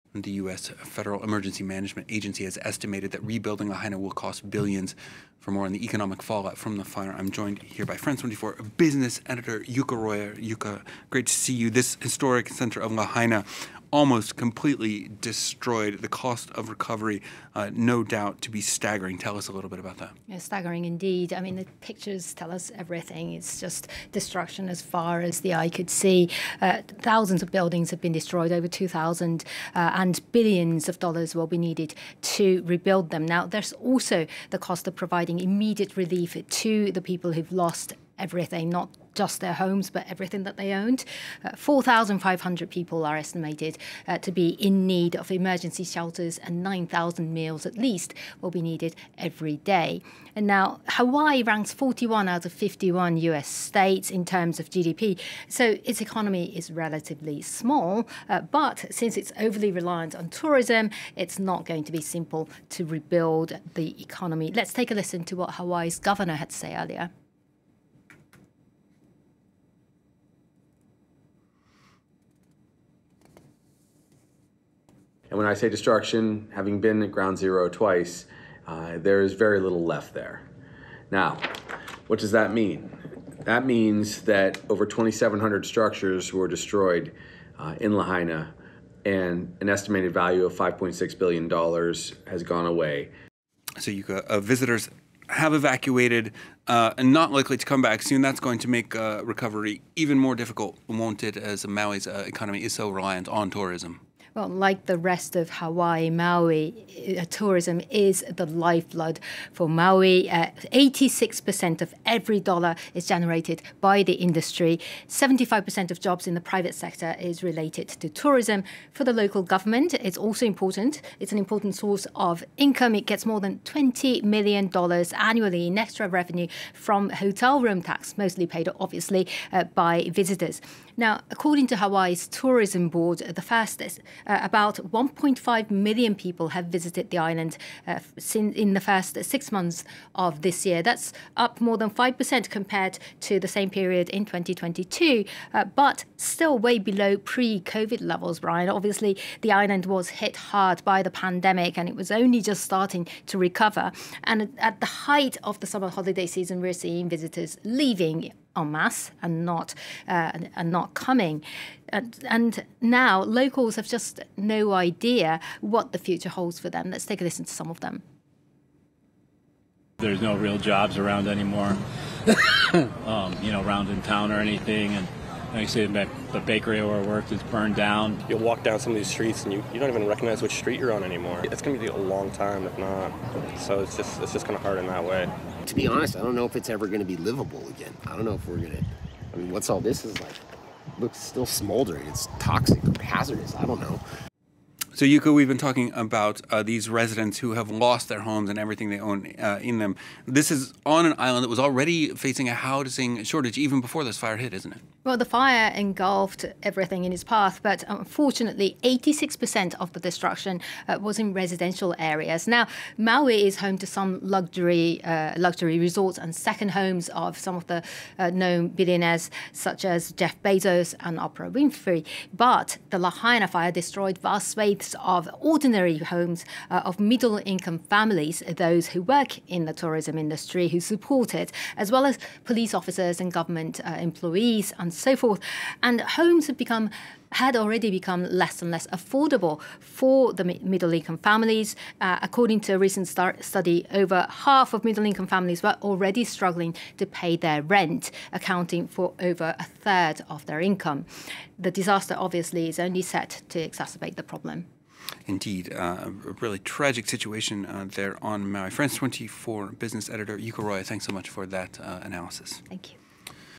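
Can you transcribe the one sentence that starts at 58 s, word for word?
Uh, but since it's overly reliant on tourism, it's not going to be simple to rebuild the economy.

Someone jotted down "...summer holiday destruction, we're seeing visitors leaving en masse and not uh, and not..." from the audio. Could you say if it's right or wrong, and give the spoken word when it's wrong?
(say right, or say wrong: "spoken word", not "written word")
wrong: "season", not "destruction".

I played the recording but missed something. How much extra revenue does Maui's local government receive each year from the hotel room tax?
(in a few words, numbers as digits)
more than $20 million.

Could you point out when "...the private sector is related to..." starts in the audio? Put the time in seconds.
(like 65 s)
116 s.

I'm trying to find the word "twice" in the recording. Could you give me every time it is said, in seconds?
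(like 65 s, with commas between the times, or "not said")
77 s.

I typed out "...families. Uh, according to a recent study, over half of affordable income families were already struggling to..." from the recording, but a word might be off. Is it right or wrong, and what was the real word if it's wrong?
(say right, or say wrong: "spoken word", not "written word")
wrong: "middle", not "affordable".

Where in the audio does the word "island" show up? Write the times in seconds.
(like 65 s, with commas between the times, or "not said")
137 s, 149 s, 201 s.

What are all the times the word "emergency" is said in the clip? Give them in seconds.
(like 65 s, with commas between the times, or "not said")
1 s, 45 s.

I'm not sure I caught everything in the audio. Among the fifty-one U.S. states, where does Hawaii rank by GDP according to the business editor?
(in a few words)
41.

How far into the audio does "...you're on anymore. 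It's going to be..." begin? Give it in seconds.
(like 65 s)
180 s.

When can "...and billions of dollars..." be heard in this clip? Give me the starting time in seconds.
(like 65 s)
29 s.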